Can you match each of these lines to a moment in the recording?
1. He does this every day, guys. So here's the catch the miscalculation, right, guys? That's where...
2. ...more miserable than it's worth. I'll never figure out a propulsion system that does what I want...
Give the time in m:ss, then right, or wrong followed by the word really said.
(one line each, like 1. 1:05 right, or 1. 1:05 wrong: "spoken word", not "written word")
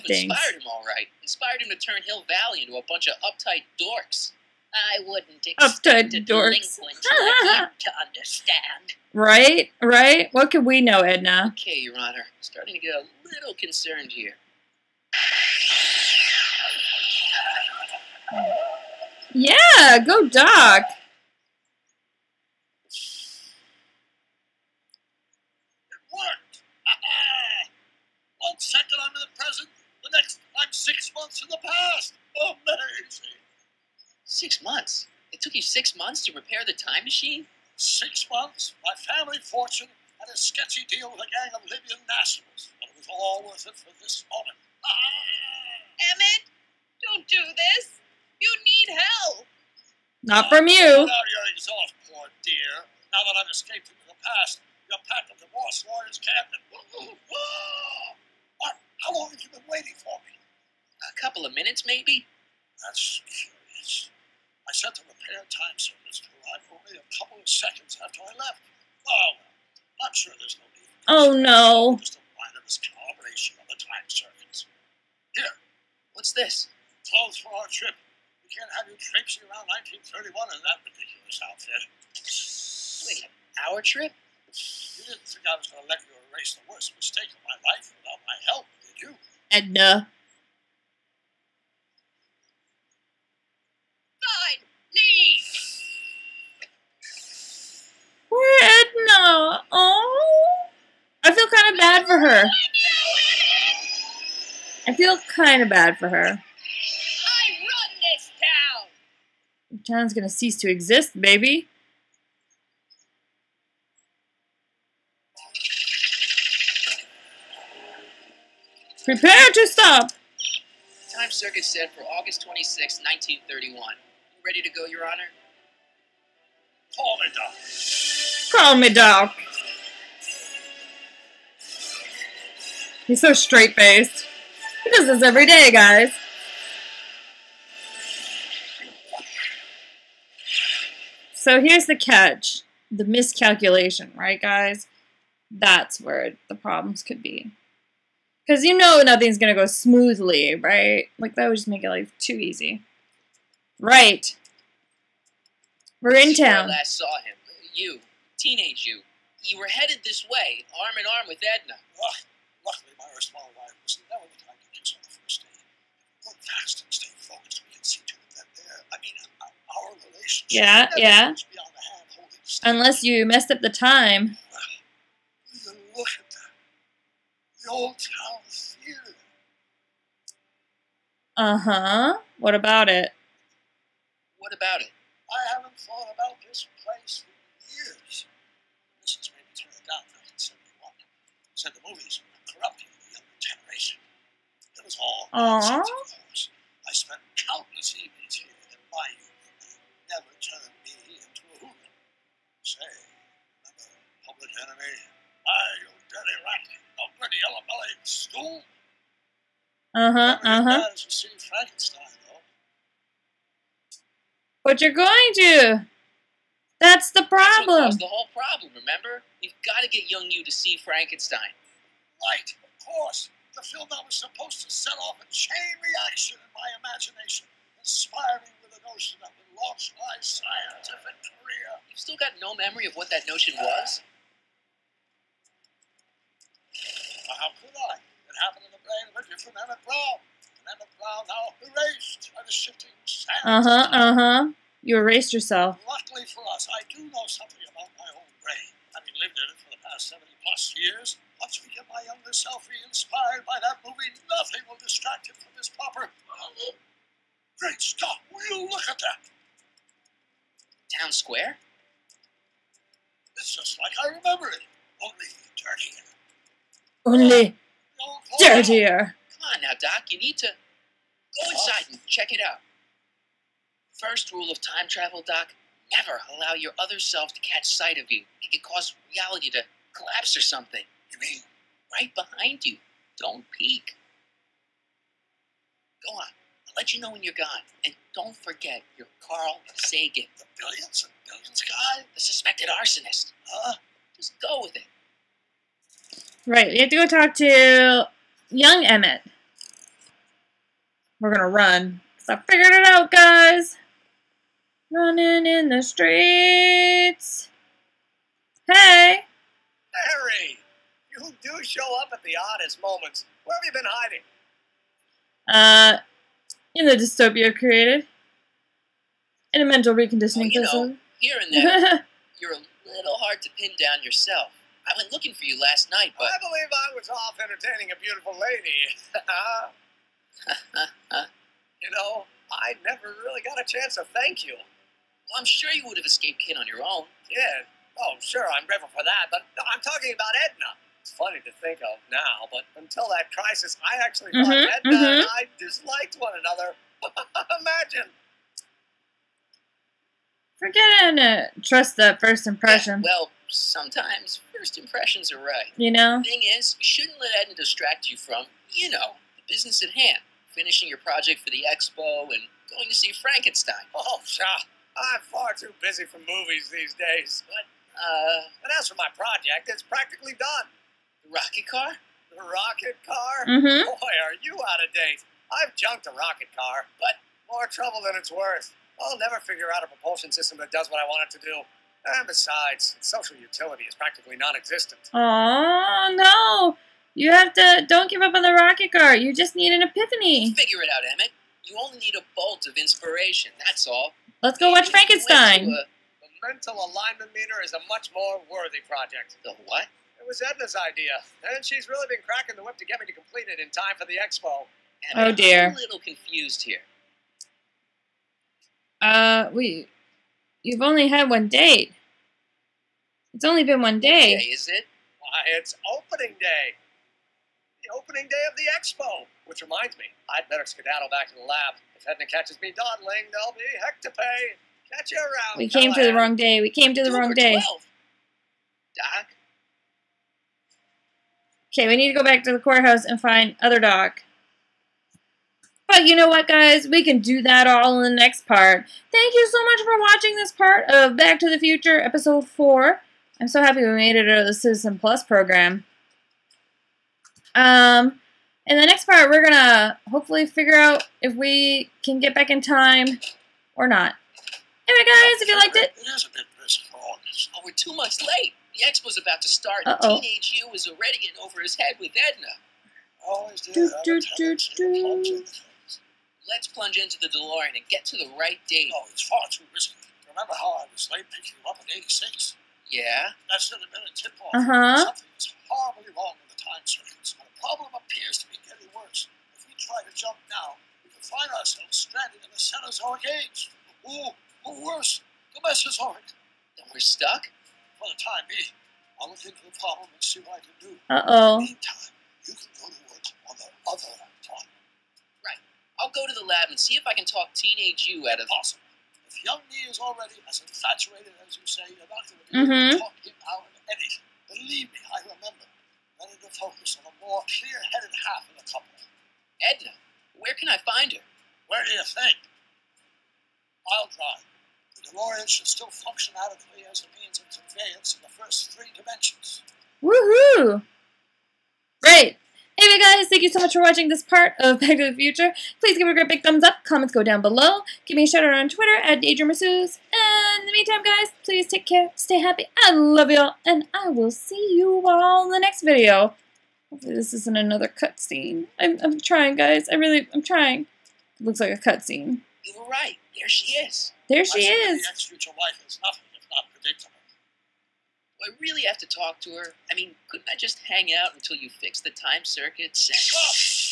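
1. 2:14 right
2. 6:17 wrong: "trouble", not "miserable".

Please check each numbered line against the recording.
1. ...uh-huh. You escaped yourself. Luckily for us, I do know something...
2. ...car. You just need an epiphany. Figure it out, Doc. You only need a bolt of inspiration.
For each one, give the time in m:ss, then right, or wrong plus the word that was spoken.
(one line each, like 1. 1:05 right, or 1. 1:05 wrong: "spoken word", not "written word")
1. 4:03 wrong: "erased", not "escaped"
2. 6:28 wrong: "Emmett", not "Doc".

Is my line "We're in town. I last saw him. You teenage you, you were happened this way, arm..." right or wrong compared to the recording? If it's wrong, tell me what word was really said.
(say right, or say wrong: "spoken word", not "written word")
wrong: "headed", not "happened".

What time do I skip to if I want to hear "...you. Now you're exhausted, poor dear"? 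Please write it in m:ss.
0:50.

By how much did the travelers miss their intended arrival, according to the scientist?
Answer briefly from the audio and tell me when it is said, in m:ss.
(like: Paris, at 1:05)
2 months, at 7:37.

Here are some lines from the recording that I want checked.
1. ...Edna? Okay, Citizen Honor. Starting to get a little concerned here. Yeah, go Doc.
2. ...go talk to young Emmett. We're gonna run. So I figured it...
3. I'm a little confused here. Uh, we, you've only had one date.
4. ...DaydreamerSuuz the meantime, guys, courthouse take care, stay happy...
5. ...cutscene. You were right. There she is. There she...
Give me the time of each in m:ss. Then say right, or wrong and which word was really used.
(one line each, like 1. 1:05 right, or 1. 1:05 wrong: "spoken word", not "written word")
1. 0:11 wrong: "Your", not "Citizen"
2. 4:56 right
3. 6:45 right
4. 8:49 wrong: "please", not "courthouse"
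5. 9:01 right.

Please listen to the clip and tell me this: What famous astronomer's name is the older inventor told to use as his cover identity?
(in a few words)
Carl Sagan.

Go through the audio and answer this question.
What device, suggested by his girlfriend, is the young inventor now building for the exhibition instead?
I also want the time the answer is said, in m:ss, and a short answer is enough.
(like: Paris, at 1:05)
mental alignment meter, at 6:36.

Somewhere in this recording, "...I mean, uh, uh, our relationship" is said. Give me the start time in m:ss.
2:48.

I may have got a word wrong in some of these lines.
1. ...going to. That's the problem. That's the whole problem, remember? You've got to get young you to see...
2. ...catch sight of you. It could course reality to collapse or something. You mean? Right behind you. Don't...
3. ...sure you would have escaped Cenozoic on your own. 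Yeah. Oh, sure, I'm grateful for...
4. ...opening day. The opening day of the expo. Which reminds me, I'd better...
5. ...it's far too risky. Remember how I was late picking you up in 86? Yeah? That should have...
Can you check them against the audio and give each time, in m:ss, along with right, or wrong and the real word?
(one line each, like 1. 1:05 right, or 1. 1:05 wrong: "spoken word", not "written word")
1. 3:34 right
2. 4:37 wrong: "cause", not "course"
3. 5:35 wrong: "Kid", not "Cenozoic"
4. 6:55 right
5. 7:49 right.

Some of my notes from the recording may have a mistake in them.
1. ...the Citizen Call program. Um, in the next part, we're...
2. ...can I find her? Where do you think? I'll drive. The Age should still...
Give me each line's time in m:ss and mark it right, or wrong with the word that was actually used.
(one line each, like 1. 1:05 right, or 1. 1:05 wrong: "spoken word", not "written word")
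1. 7:24 wrong: "Plus", not "Call"
2. 8:30 wrong: "DeLorean", not "Age".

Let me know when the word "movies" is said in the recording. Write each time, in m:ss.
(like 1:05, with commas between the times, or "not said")
3:11, 4:13, 6:06.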